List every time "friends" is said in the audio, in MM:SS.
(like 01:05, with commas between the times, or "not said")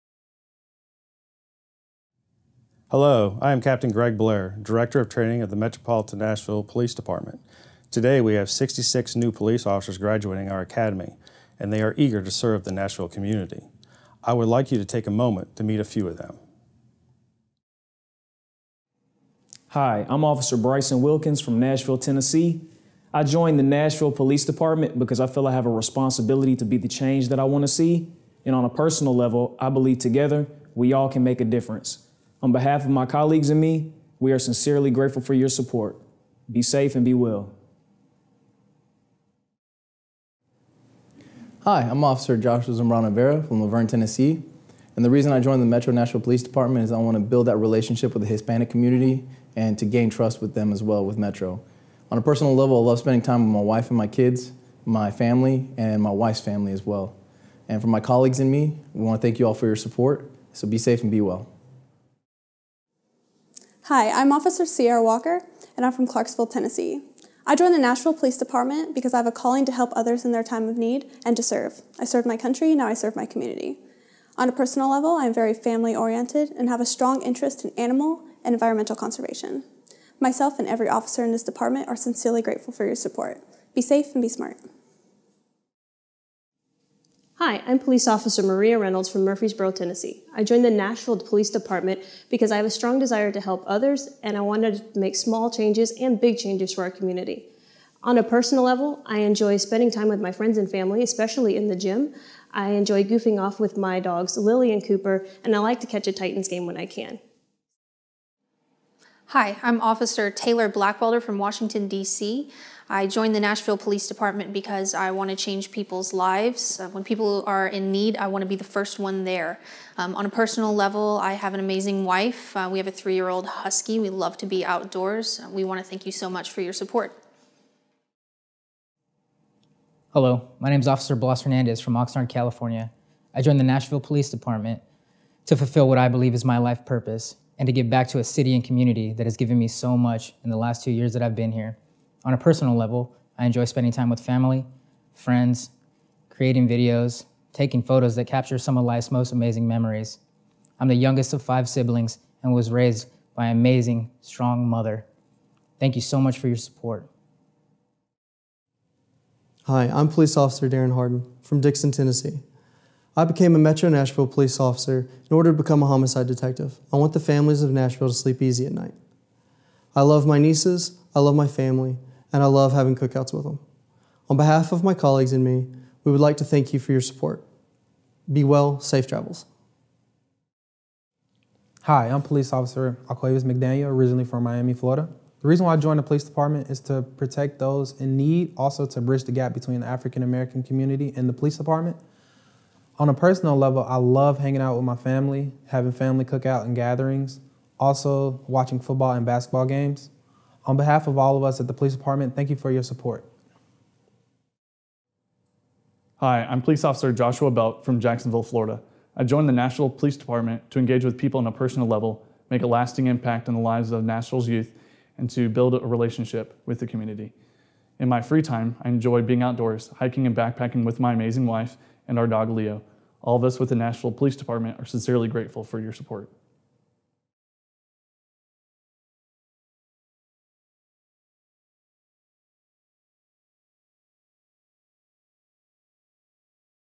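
01:40, 02:25.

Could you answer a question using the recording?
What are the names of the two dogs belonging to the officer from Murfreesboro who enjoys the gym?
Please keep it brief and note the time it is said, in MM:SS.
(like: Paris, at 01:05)
Lily and Cooper, at 01:44.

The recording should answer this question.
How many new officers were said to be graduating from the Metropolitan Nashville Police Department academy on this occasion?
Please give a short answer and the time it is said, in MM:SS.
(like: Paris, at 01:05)
66, at 00:08.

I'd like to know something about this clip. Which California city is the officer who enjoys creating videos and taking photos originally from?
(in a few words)
Oxnard.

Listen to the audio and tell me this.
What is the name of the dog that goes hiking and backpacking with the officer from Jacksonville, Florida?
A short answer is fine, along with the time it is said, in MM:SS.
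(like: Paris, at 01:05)
Leo, at 03:42.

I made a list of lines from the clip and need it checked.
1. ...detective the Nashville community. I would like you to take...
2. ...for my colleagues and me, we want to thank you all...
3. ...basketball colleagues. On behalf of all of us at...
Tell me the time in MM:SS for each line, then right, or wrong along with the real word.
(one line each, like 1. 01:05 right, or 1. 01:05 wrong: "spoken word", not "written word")
1. 00:12 wrong: "serve", not "detective"
2. 00:57 right
3. 03:19 wrong: "games", not "colleagues".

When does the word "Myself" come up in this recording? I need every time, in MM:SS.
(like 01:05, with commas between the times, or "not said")
01:20.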